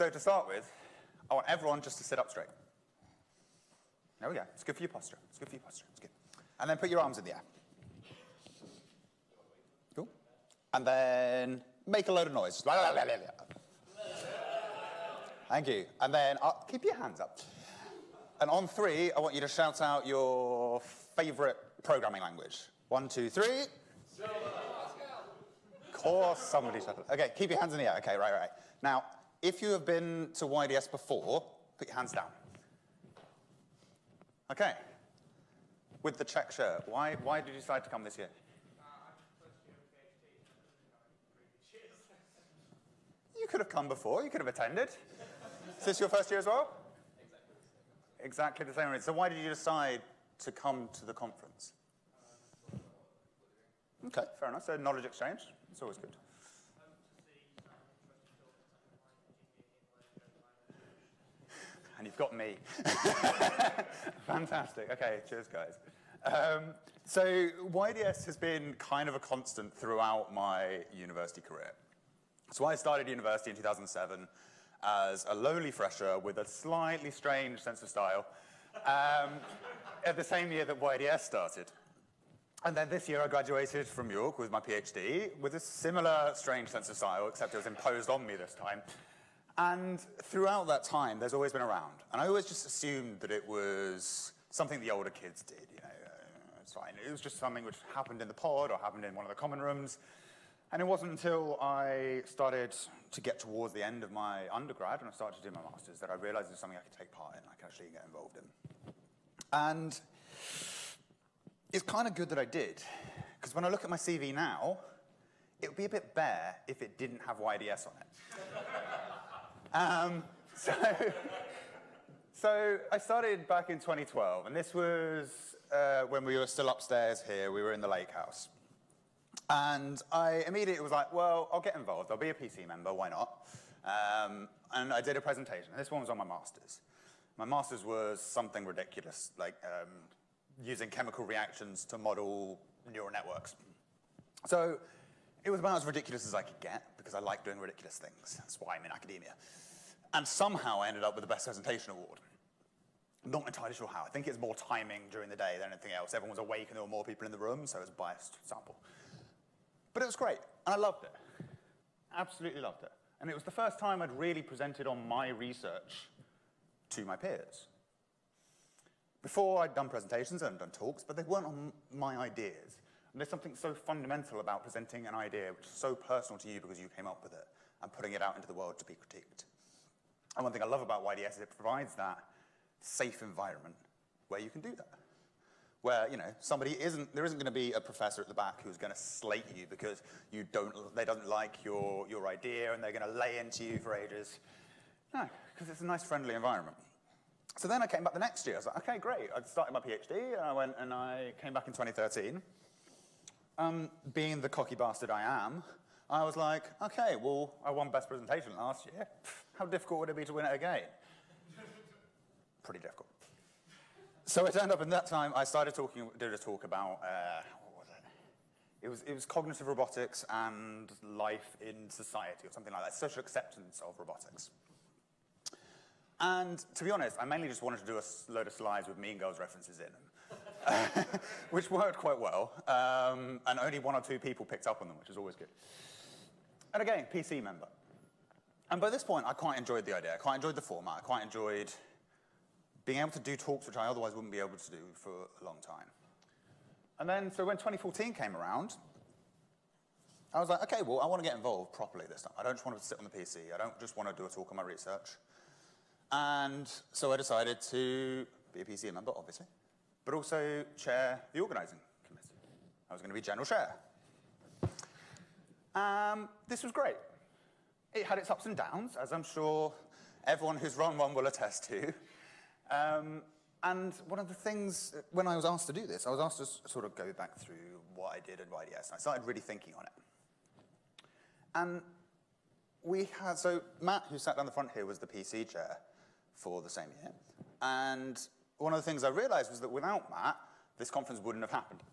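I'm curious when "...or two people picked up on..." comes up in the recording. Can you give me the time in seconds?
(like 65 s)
233 s.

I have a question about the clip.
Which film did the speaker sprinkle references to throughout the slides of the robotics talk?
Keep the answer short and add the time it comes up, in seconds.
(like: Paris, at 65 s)
Mean Girls, at 228 s.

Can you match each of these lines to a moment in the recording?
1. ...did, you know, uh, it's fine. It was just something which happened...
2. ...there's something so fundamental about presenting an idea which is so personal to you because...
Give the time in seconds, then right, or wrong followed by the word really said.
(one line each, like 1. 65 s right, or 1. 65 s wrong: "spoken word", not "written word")
1. 95 s right
2. 173 s right.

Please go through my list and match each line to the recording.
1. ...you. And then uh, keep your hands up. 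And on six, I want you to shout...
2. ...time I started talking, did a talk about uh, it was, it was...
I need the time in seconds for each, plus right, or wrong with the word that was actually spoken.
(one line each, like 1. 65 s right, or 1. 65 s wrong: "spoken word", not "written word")
1. 15 s wrong: "three", not "six"
2. 215 s right.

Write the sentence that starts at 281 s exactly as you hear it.
And we had, so Matt, who sat down the front here, was the PC chair for the same year.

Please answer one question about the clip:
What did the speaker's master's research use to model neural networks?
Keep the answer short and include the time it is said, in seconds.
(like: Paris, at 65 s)
chemical reactions, at 140 s.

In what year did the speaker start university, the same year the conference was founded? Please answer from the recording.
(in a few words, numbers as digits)
2007.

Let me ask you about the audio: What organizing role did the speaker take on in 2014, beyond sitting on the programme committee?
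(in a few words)
general chair.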